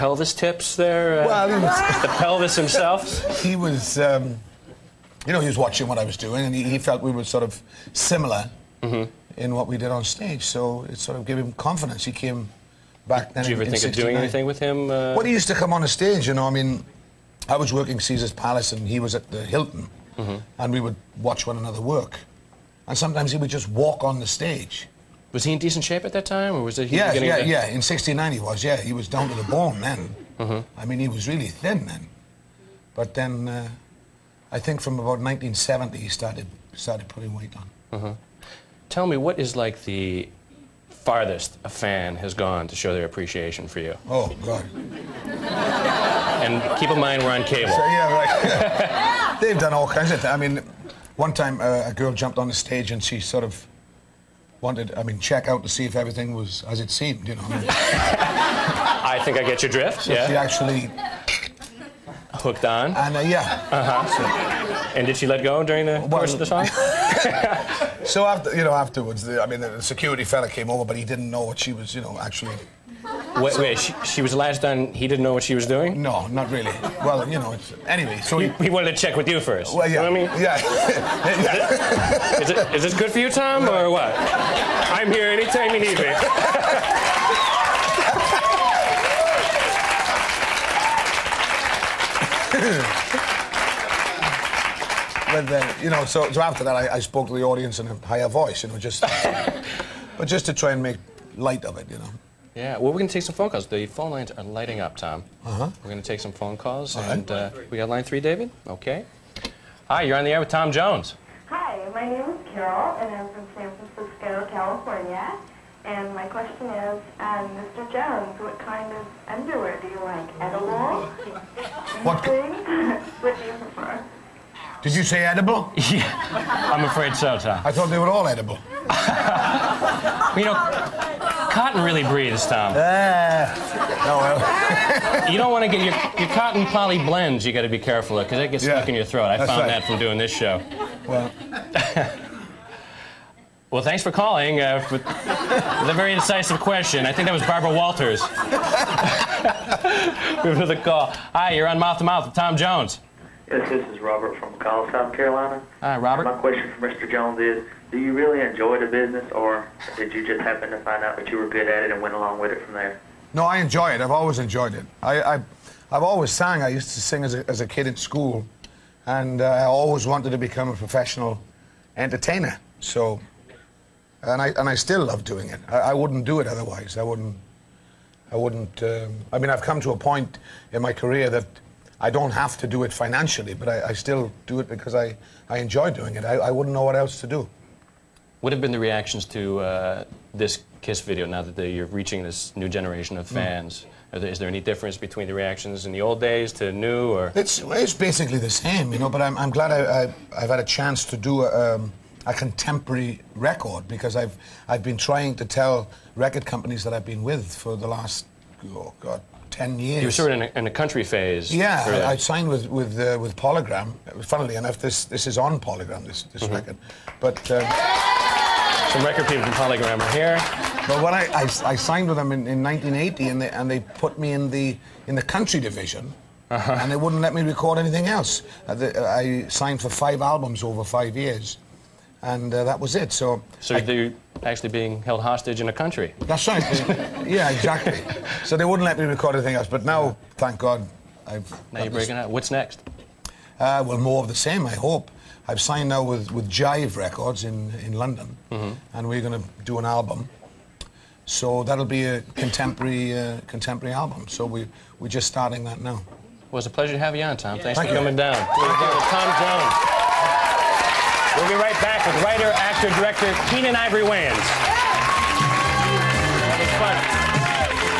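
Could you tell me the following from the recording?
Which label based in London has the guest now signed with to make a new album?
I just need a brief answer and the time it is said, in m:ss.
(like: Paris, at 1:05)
Jive Records, at 4:06.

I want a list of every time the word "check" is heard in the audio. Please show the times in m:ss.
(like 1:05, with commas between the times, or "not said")
0:55, 1:18.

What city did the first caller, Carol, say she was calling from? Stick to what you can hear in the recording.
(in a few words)
San Francisco.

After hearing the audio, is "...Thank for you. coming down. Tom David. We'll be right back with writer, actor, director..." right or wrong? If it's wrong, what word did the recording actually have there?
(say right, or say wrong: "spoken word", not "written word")
wrong: "Jones", not "David".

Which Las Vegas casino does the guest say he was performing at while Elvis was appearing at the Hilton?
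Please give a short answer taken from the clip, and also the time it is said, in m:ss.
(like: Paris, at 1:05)
Caesar's Palace, at 0:18.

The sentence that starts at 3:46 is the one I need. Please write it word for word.
and they wouldn't let me record anything else.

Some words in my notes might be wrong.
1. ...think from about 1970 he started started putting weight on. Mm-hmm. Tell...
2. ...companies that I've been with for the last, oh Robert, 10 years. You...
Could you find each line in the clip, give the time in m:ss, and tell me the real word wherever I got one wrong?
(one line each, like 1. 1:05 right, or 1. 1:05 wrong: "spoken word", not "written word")
1. 0:34 right
2. 3:26 wrong: "God", not "Robert".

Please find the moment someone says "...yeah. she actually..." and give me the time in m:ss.
1:00.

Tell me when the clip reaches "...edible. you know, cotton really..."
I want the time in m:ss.
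2:08.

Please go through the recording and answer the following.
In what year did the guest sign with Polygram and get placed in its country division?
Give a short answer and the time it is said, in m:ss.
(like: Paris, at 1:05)
1980, at 3:42.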